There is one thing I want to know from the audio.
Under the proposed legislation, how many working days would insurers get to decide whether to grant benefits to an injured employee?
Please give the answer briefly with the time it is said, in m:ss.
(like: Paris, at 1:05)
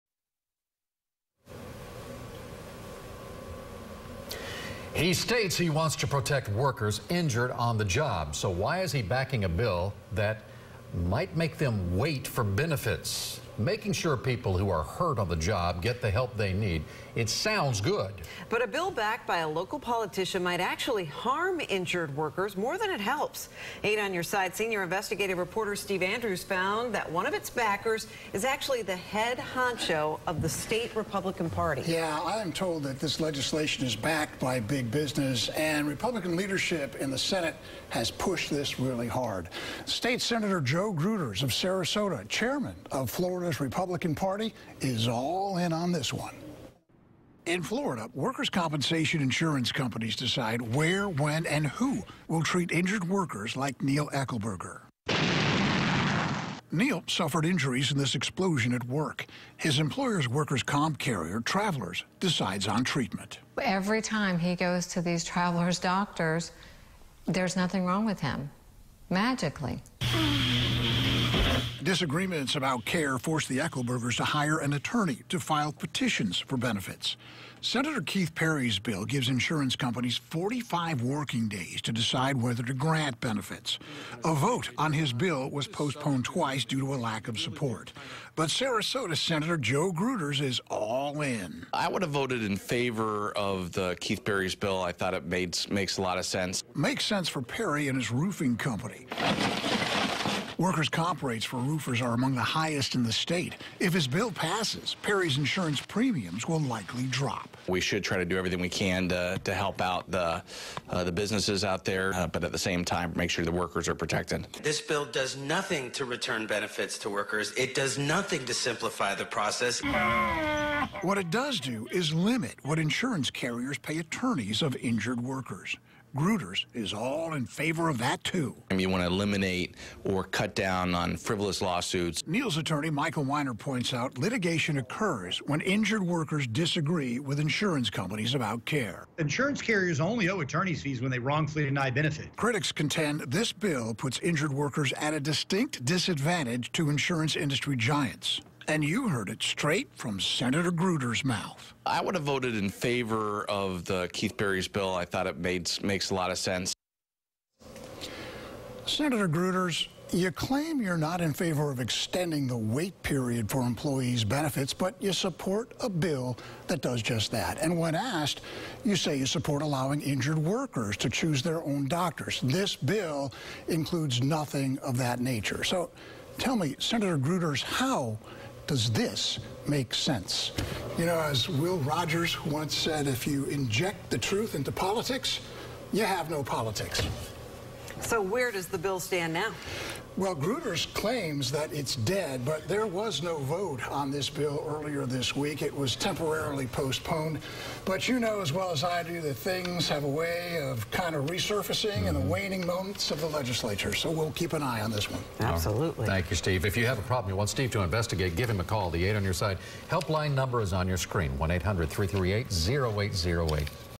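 45, at 1:20.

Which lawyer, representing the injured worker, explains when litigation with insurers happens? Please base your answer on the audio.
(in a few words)
Michael Weiner.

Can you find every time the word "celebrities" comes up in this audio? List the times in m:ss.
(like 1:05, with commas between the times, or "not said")
not said.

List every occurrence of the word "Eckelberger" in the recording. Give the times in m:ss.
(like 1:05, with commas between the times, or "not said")
0:54, 1:13.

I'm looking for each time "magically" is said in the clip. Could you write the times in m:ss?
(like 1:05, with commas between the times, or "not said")
1:09.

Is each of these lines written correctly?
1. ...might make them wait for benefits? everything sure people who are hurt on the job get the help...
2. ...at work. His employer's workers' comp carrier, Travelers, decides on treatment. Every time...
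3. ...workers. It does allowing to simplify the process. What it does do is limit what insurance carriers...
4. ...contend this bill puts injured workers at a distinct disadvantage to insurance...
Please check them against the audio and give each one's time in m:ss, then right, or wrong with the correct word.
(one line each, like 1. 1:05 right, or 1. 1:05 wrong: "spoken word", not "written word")
1. 0:11 wrong: "making", not "everything"
2. 0:58 right
3. 1:57 wrong: "nothing", not "allowing"
4. 2:22 right.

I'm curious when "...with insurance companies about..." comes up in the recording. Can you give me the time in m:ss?
2:17.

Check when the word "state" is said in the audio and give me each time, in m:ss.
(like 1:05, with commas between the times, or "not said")
0:05, 0:30, 0:39, 1:43.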